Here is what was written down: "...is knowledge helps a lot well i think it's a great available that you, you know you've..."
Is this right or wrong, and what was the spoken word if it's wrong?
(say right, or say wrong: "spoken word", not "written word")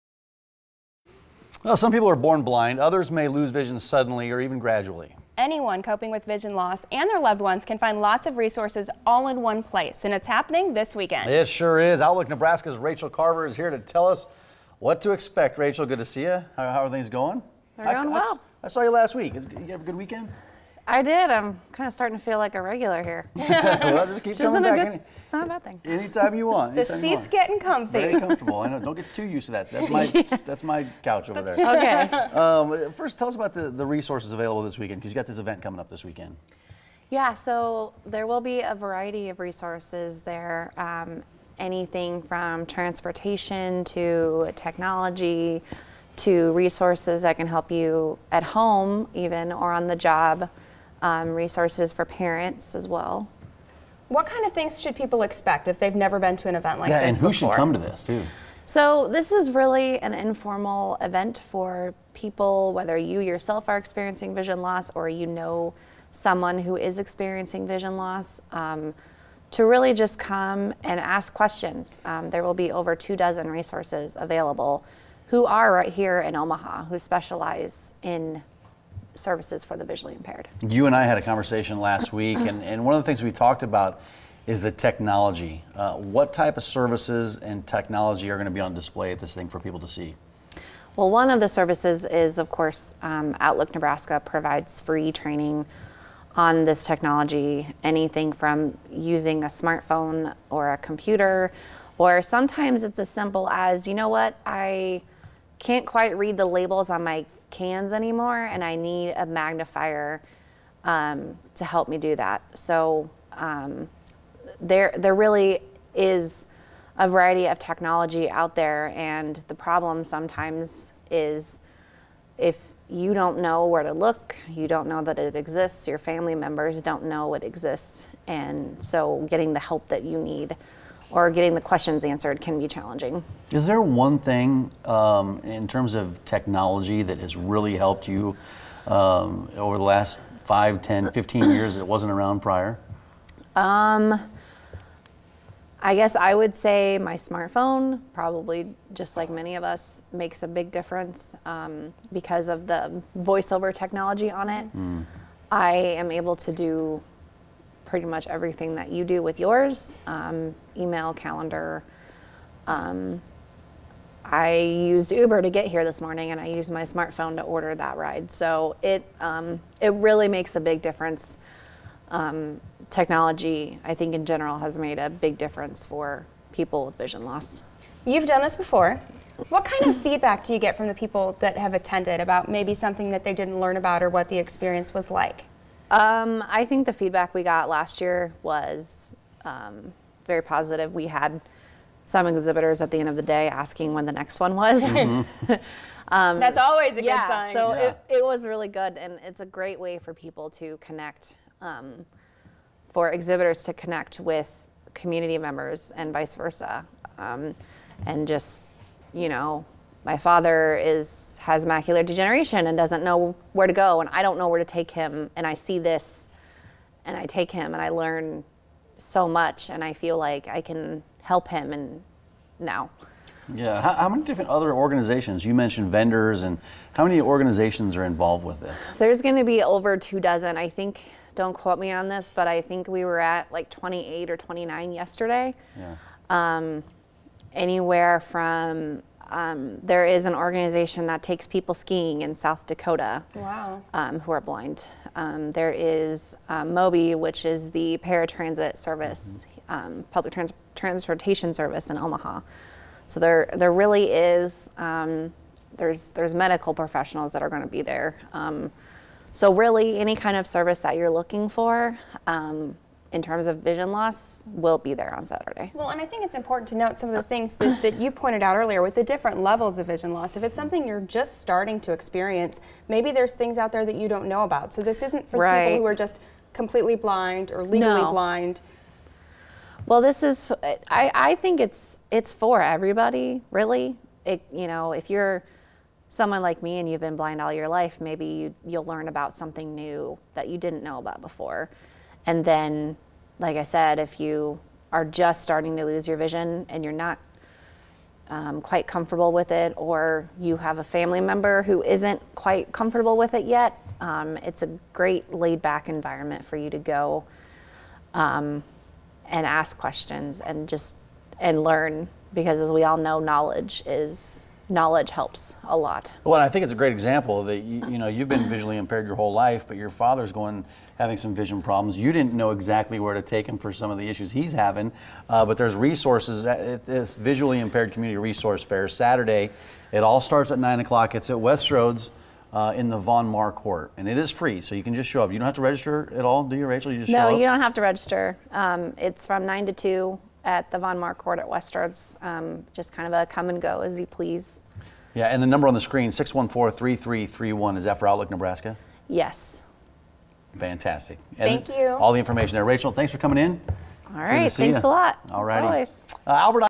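wrong: "example", not "available".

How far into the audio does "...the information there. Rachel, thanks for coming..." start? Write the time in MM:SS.
05:52.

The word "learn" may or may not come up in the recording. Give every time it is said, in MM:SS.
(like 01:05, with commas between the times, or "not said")
03:03, 03:37, 04:48, 05:11.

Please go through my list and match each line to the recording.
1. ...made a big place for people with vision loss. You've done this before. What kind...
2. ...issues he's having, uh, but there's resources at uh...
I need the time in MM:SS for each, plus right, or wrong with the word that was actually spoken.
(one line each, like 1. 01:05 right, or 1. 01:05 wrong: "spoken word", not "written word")
1. 02:54 wrong: "difference", not "place"
2. 05:24 right.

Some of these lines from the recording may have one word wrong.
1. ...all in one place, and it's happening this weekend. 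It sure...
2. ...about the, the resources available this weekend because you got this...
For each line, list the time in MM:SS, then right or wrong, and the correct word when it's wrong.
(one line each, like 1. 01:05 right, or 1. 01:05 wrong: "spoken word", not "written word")
1. 00:09 right
2. 00:33 right.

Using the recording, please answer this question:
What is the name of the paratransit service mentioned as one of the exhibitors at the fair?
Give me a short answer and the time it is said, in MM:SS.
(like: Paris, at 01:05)
MOBY, at 04:06.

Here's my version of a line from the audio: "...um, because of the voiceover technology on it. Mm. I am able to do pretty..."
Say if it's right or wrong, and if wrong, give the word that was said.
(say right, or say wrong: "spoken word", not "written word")
right.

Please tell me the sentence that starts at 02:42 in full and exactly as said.
Um, I used Uber to get here this morning and I used my smartphone to order that ride.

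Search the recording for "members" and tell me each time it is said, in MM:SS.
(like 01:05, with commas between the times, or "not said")
02:06, 03:25, 05:01.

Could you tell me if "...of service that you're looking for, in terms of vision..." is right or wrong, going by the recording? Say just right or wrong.
right.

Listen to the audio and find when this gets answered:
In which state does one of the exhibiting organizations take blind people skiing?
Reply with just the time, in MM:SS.
04:02.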